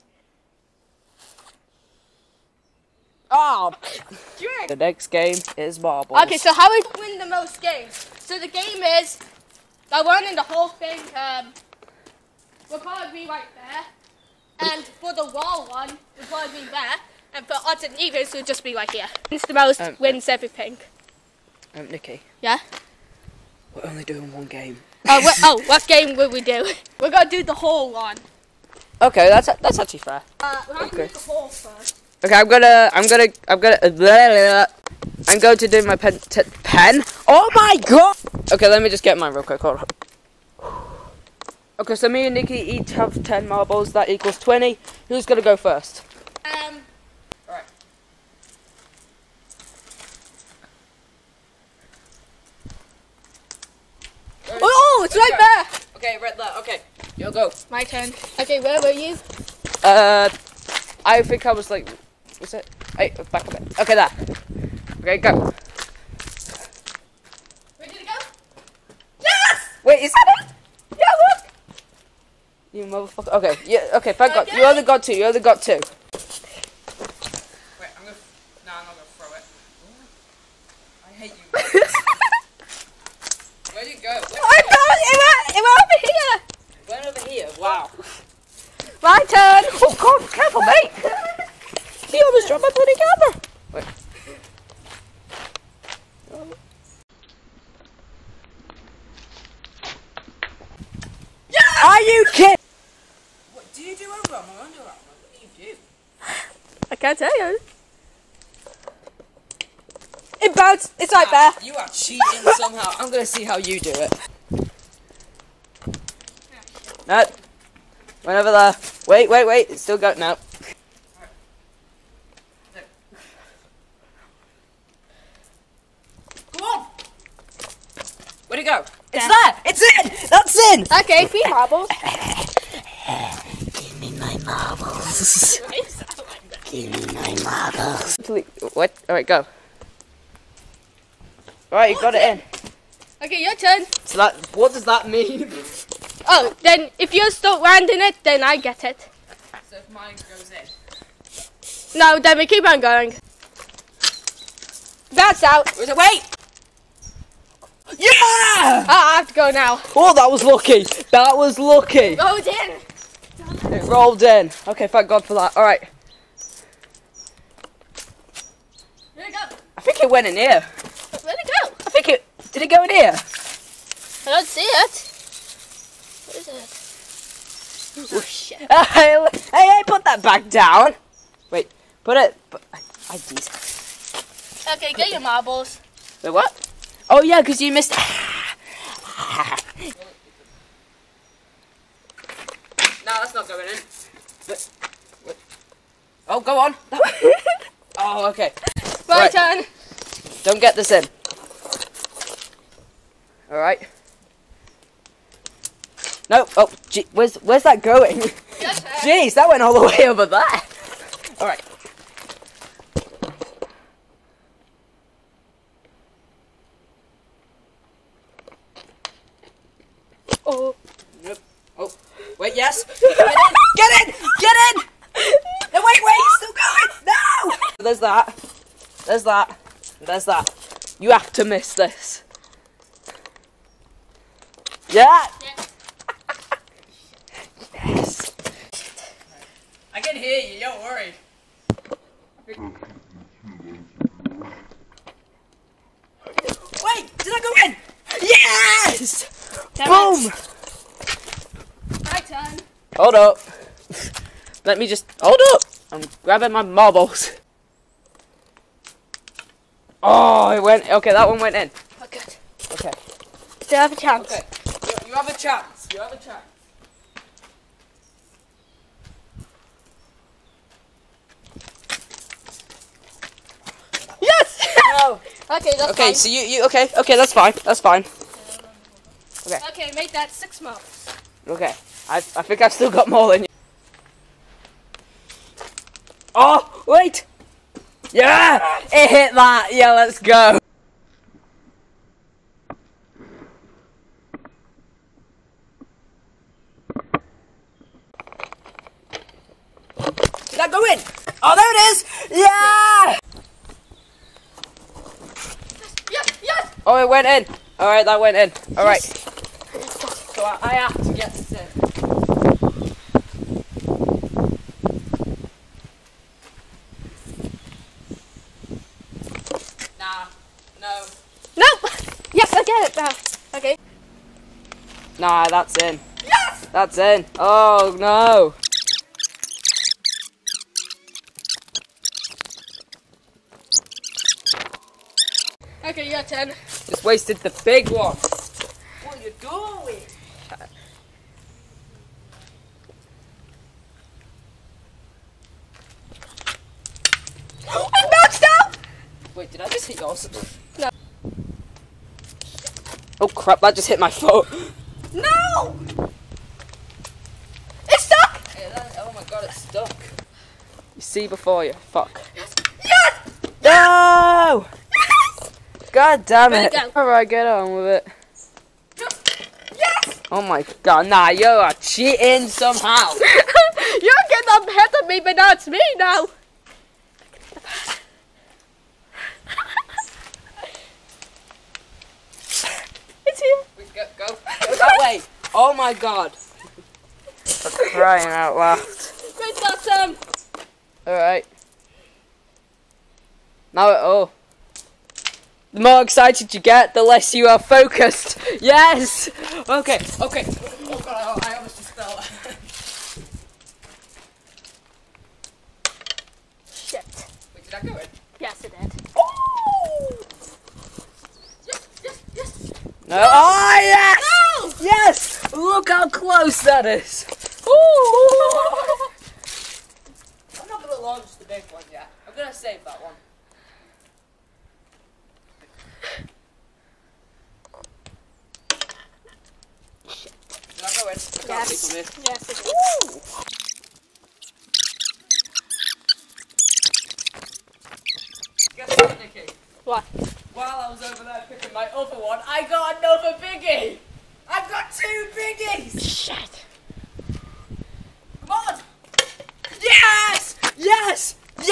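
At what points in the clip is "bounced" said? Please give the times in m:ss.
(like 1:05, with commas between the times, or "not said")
1:50, 5:48.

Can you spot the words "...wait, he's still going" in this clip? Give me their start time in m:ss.
3:46.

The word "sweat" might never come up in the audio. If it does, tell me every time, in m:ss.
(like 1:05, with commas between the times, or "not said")
not said.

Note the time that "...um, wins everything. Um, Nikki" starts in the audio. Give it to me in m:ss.
0:19.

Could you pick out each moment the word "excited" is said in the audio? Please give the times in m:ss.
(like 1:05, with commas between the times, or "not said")
6:36.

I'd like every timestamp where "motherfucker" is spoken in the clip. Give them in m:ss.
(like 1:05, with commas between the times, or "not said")
1:12.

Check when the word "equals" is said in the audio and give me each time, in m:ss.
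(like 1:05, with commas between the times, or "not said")
0:44.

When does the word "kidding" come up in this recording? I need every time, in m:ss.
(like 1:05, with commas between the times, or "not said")
1:42.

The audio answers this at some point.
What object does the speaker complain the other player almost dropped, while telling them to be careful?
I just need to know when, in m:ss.
1:32.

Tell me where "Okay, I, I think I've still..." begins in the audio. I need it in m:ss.
4:41.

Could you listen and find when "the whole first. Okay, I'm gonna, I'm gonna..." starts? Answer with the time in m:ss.
0:31.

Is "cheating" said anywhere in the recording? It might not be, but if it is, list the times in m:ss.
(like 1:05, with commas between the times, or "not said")
1:51, 6:11.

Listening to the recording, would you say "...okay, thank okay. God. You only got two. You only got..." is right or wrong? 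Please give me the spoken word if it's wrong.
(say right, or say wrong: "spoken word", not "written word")
right.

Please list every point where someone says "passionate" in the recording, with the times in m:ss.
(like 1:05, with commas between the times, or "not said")
not said.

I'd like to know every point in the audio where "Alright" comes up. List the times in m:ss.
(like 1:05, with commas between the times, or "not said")
3:31, 6:06, 6:31.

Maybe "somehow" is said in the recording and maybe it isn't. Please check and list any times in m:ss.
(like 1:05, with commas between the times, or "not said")
1:52, 6:12.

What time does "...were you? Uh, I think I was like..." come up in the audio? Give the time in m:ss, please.
0:58.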